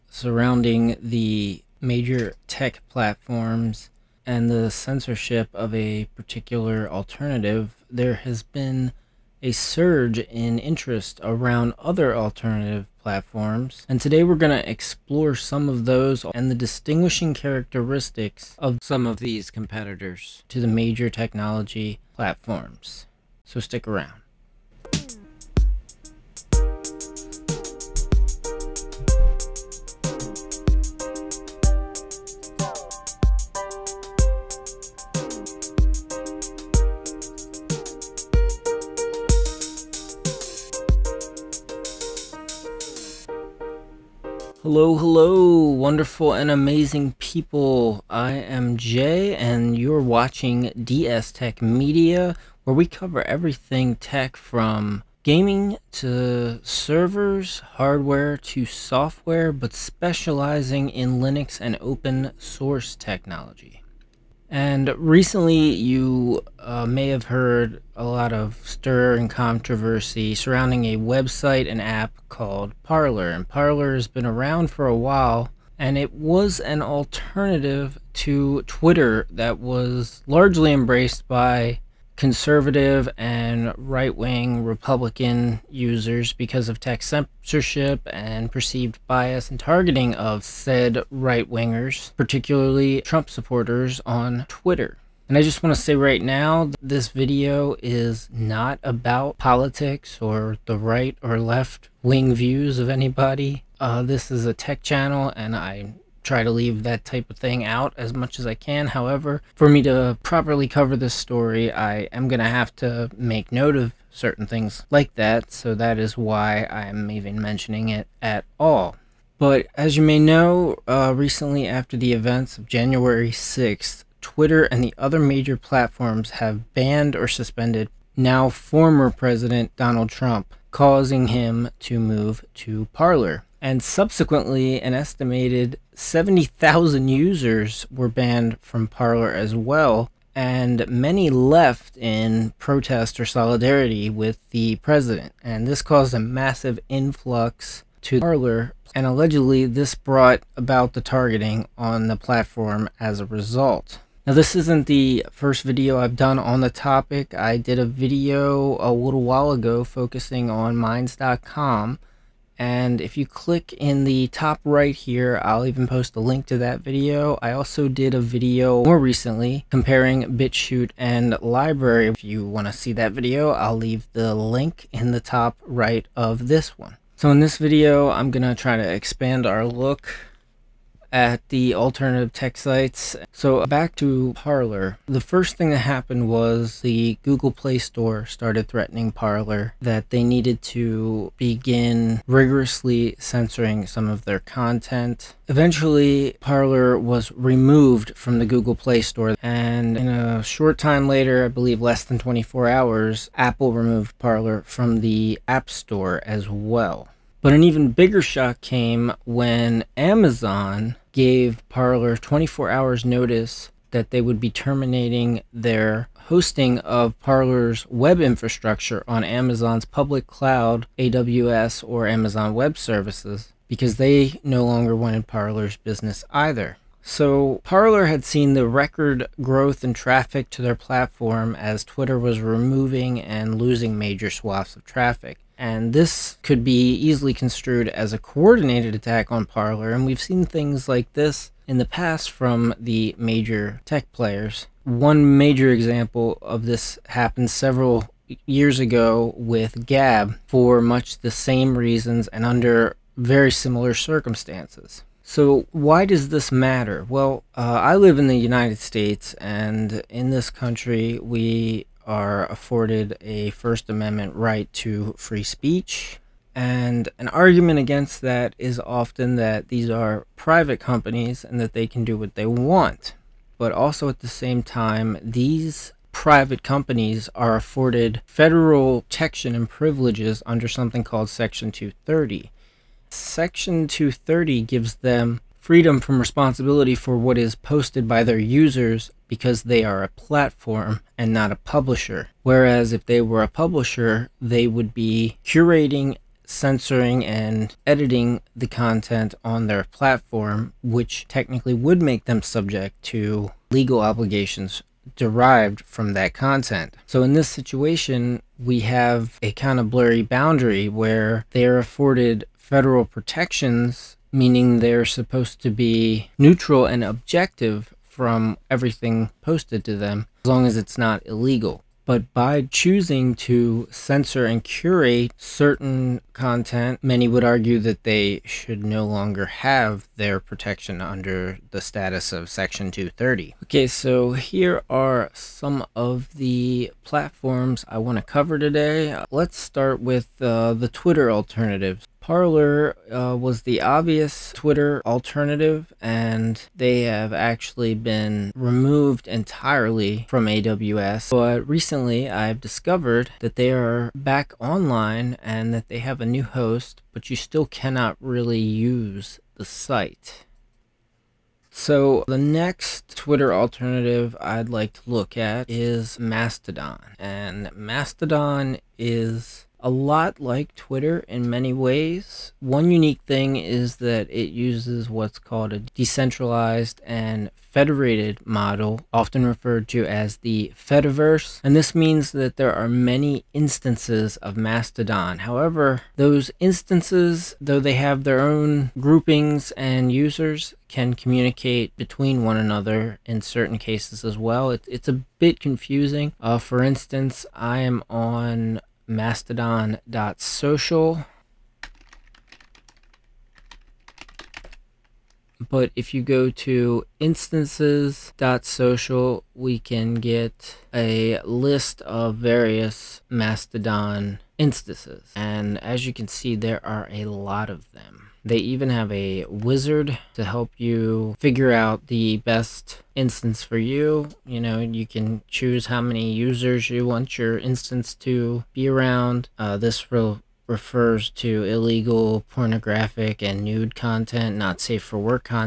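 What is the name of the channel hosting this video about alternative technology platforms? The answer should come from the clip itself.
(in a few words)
DS Tech Media.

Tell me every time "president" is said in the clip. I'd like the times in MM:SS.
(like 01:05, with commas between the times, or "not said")
02:09, 02:24.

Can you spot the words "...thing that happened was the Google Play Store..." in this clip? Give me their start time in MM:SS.
03:05.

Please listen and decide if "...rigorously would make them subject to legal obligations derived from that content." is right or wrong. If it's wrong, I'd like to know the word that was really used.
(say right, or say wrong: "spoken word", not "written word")
wrong: "technically", not "rigorously".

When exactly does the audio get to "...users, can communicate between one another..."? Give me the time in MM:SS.
06:30.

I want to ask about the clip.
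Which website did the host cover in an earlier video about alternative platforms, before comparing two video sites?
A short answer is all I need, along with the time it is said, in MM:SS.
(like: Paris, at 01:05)
Minds.com, at 02:40.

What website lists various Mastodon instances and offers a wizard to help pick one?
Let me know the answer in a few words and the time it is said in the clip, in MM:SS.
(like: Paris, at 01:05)
instances.social, at 06:47.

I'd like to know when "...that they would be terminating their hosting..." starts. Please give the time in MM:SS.
03:33.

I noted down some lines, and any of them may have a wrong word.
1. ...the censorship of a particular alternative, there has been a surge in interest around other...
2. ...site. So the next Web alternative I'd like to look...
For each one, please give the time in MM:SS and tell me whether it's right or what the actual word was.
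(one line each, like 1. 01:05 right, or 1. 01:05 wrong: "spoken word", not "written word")
1. 00:04 right
2. 05:59 wrong: "Twitter", not "Web".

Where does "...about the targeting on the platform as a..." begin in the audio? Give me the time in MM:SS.
02:30.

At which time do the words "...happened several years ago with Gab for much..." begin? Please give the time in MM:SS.
04:07.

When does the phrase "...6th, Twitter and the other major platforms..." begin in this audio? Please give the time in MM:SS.
02:03.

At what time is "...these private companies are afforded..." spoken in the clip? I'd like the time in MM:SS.
04:35.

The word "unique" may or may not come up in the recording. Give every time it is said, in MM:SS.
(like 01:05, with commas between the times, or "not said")
06:12.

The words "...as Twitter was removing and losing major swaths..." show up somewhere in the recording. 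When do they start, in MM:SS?
03:51.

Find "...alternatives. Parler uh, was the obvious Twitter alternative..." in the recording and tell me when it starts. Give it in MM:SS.
05:41.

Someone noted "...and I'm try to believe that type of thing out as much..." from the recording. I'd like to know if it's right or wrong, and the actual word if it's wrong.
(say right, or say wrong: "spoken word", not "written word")
wrong: "leave", not "believe".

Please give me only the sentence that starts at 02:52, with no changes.
If you want to see that video, I'll leave the link in the top right of this one.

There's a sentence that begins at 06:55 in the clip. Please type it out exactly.
And as you can see, there are a lot of them.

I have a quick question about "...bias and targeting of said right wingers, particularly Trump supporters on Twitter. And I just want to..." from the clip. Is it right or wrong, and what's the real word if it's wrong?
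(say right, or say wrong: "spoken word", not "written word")
right.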